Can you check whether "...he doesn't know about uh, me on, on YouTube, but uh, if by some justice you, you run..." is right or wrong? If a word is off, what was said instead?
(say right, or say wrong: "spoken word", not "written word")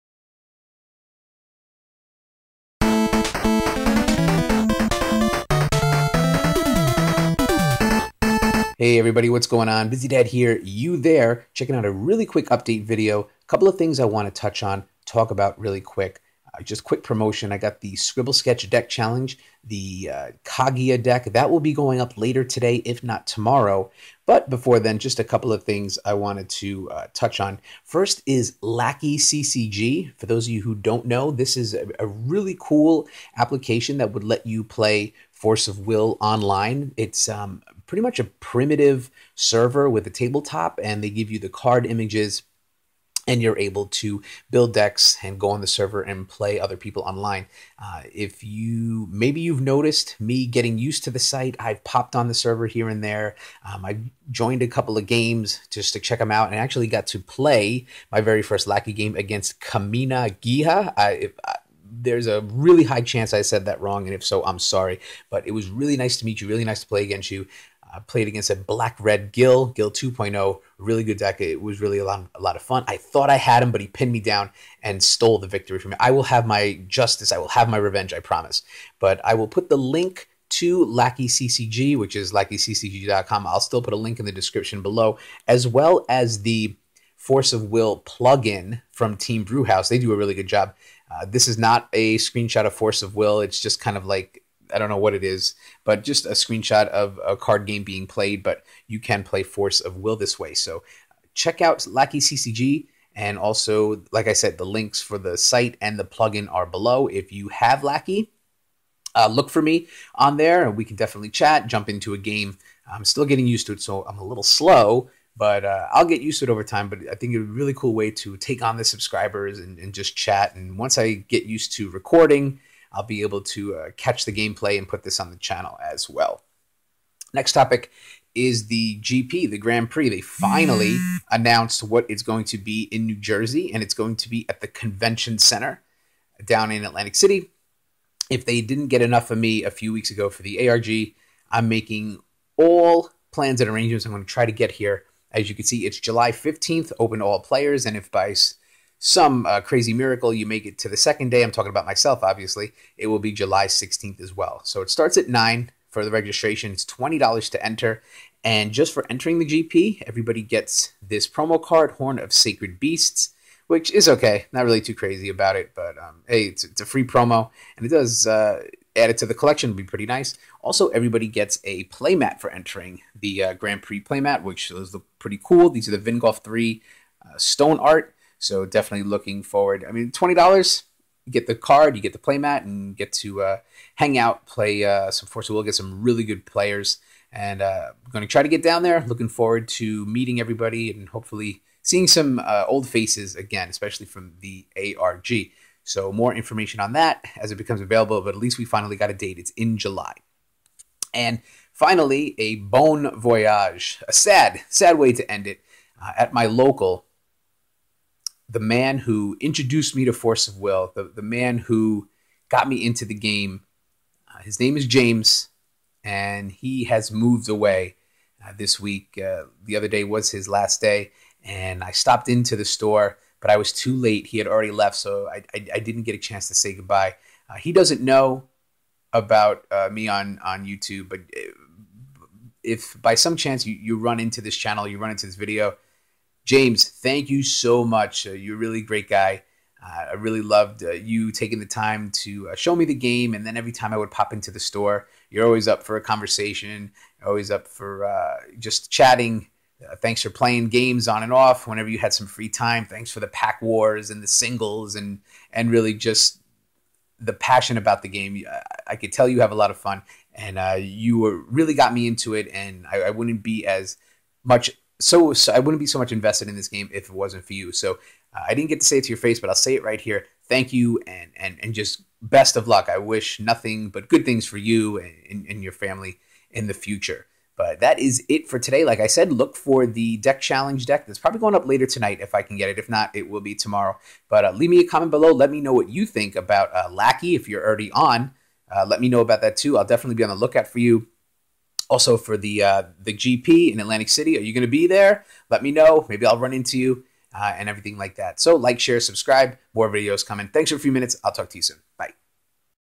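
wrong: "chance", not "justice".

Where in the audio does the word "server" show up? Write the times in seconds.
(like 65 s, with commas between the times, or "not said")
39 s, 45 s, 52 s.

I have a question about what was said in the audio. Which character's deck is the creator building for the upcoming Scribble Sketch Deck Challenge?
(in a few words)
Kaguya.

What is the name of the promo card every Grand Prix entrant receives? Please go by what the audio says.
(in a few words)
Horn of Sacred Beasts.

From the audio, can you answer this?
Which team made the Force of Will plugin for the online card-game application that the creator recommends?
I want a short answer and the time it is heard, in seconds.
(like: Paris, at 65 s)
Team Brewhouse, at 89 s.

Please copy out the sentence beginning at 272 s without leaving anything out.
I wish nothing but good things for you and, and, and your family in the future.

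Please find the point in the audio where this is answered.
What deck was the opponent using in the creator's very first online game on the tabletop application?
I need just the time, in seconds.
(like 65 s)
68 s.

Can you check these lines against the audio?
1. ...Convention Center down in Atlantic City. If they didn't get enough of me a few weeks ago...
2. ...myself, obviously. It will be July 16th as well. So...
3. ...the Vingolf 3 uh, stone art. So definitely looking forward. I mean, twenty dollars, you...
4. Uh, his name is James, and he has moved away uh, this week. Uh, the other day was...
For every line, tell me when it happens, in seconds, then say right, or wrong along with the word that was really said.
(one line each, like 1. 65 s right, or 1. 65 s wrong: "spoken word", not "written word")
1. 134 s right
2. 151 s right
3. 175 s right
4. 214 s right.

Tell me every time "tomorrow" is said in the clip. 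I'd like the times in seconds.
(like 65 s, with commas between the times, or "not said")
23 s, 283 s.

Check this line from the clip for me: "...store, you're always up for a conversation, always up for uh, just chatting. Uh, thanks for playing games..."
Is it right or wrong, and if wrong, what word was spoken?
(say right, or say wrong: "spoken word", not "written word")
right.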